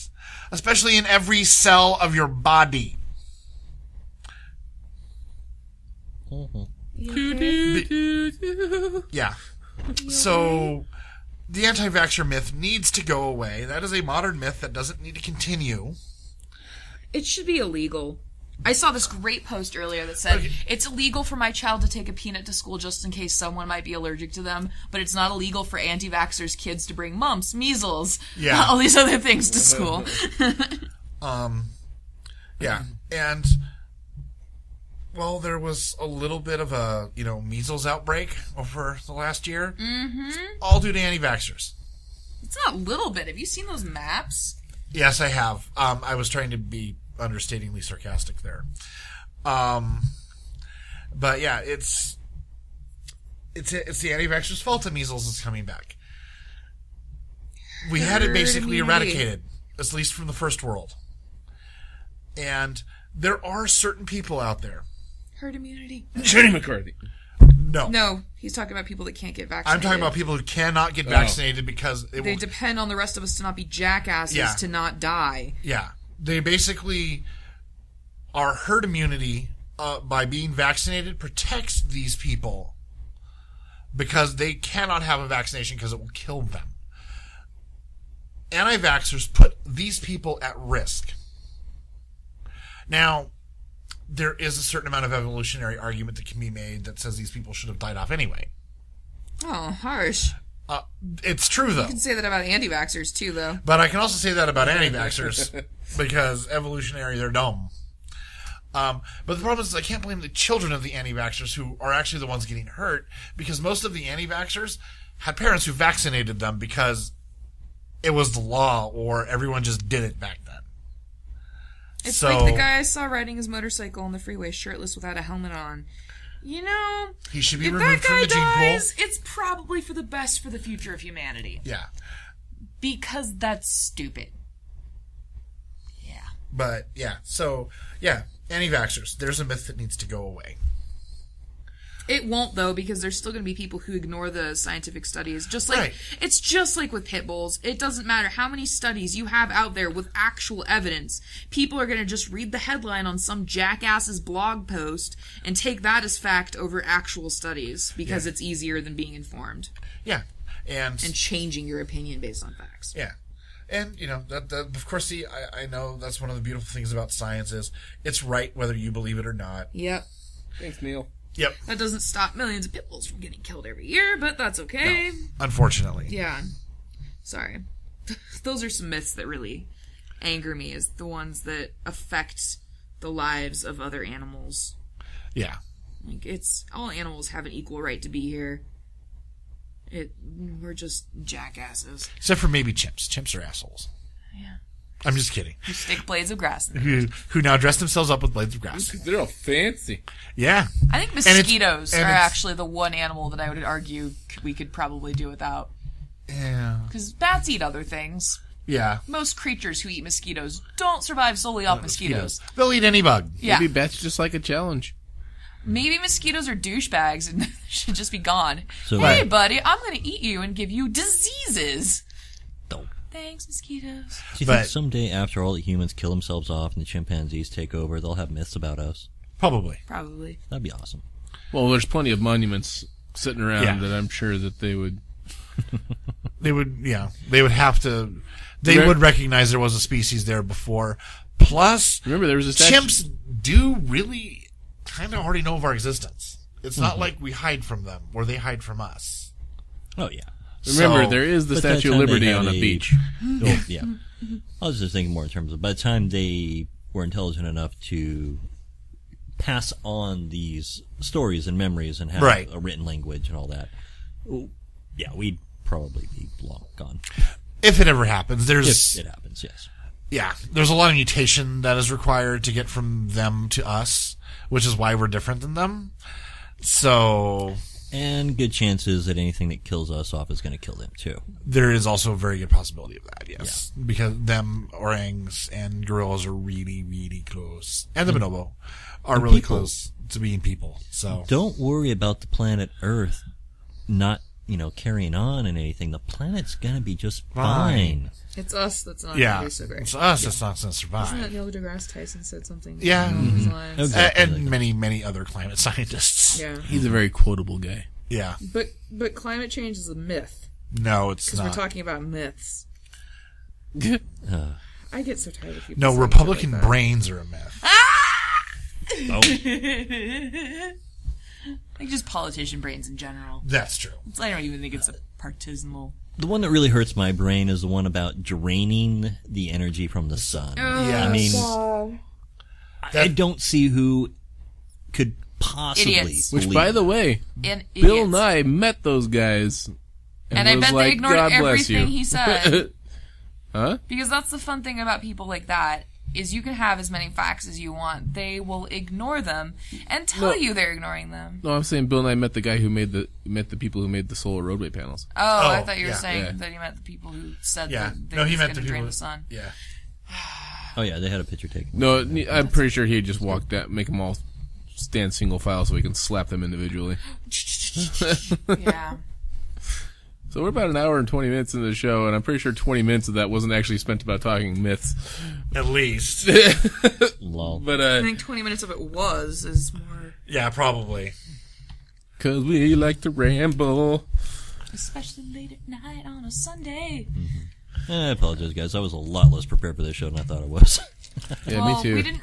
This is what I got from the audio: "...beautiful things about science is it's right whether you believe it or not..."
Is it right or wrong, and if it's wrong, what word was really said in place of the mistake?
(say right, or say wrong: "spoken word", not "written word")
right.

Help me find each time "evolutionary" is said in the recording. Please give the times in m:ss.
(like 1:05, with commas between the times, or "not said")
1:35, 1:46.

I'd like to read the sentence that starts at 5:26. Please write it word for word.
The one that really hurts my brain is the one about draining the energy from the sun.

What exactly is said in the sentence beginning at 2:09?
It's probably for the best for the future of humanity.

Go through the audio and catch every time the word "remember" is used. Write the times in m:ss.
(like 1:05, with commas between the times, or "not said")
4:02, 4:10.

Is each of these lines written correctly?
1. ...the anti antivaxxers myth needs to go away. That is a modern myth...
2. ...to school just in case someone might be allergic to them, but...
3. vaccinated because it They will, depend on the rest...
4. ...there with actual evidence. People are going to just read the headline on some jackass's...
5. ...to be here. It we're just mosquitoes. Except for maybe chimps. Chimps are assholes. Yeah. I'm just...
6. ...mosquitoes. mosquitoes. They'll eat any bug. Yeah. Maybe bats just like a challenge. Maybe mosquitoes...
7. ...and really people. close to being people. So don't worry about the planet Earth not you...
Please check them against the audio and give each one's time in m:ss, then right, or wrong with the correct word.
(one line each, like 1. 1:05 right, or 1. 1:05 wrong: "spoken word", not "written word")
1. 0:11 wrong: "vaxxer", not "antivaxxers"
2. 0:22 right
3. 1:11 right
4. 2:29 right
5. 3:08 wrong: "jackasses", not "mosquitoes"
6. 3:31 right
7. 4:49 right.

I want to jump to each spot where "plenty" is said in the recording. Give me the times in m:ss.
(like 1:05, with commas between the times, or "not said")
3:51.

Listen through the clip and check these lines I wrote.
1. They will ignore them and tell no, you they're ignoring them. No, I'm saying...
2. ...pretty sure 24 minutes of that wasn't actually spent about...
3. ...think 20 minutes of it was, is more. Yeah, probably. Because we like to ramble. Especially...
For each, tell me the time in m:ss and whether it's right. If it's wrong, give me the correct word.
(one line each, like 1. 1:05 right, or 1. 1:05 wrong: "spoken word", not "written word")
1. 5:48 right
2. 6:12 wrong: "20", not "24"
3. 6:17 right.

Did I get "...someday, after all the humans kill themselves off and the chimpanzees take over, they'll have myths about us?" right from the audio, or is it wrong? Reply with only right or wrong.
right.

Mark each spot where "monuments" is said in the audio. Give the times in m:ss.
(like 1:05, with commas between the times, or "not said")
3:52.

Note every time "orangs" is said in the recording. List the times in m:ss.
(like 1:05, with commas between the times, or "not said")
4:44.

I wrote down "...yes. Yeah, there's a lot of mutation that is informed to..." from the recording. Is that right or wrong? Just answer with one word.
wrong.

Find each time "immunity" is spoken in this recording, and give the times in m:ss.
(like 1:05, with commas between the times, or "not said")
1:05, 1:18.